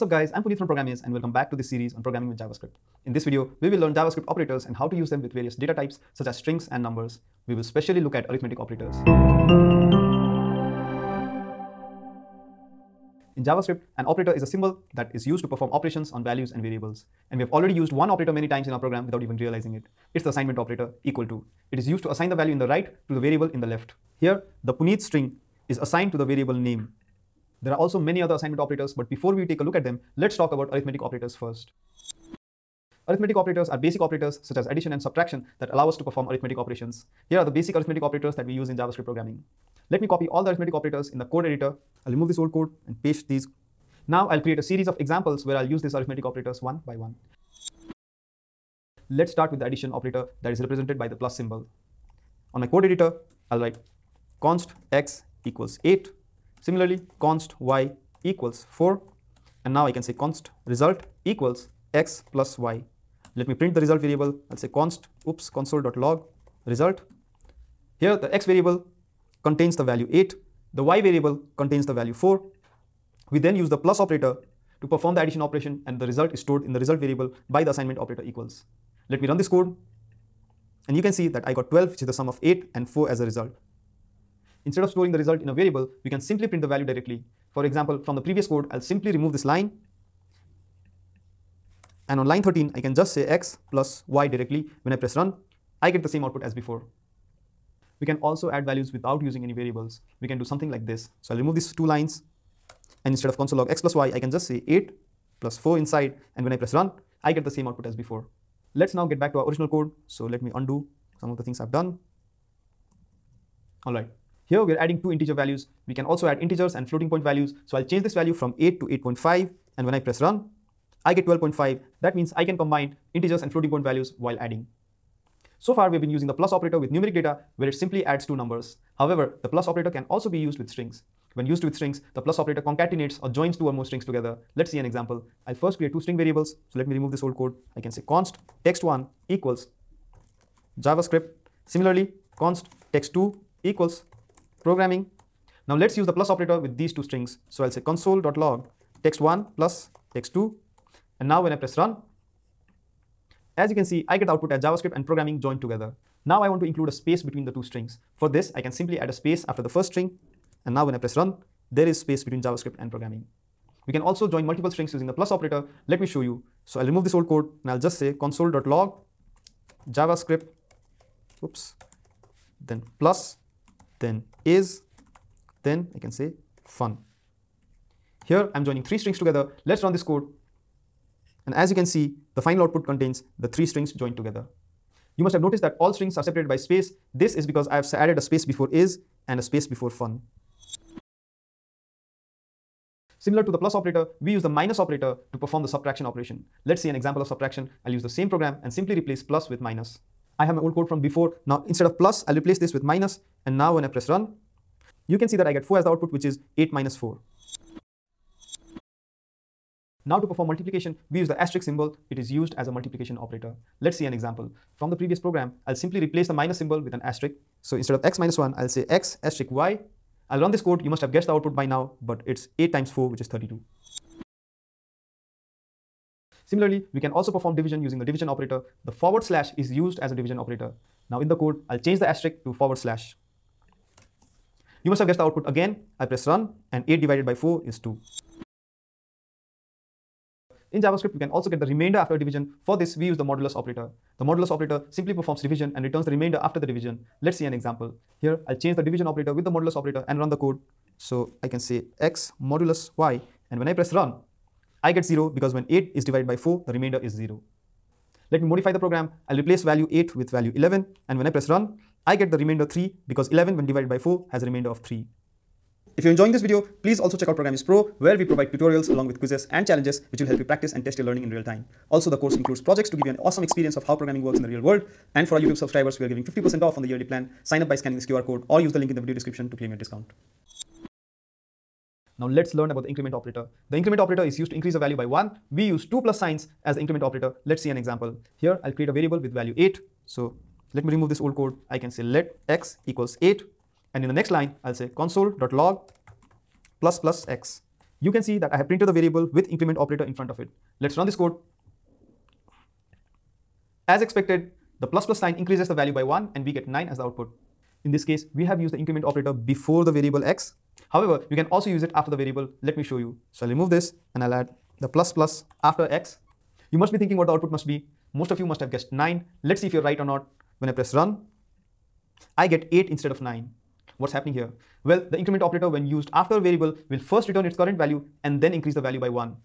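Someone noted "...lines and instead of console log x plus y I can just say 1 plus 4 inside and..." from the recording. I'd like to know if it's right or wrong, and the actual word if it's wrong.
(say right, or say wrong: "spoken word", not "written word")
wrong: "8", not "1".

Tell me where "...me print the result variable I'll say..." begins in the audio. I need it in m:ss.
1:03.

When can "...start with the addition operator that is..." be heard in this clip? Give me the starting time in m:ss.
0:49.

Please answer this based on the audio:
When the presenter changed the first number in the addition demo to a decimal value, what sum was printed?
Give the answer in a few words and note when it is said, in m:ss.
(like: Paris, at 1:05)
12.5, at 2:01.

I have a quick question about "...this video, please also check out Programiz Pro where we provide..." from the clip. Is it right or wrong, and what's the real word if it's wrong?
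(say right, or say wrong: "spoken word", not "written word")
right.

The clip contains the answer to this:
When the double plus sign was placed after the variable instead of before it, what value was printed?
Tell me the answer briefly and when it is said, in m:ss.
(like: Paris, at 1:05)
8, at 5:22.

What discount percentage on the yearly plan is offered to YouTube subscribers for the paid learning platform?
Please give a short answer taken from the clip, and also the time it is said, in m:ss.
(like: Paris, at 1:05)
50%, at 4:36.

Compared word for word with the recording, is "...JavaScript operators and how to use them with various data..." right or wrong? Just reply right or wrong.
right.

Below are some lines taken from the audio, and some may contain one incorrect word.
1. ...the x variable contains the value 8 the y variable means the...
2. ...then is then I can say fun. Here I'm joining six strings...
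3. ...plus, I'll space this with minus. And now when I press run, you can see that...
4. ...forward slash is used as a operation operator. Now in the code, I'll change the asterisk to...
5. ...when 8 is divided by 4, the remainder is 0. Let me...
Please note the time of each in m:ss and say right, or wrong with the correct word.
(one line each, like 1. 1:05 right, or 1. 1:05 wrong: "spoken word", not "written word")
1. 1:08 wrong: "contains", not "means"
2. 2:54 wrong: "three", not "six"
3. 3:21 wrong: "replace", not "space"
4. 3:48 wrong: "division", not "operation"
5. 4:15 right.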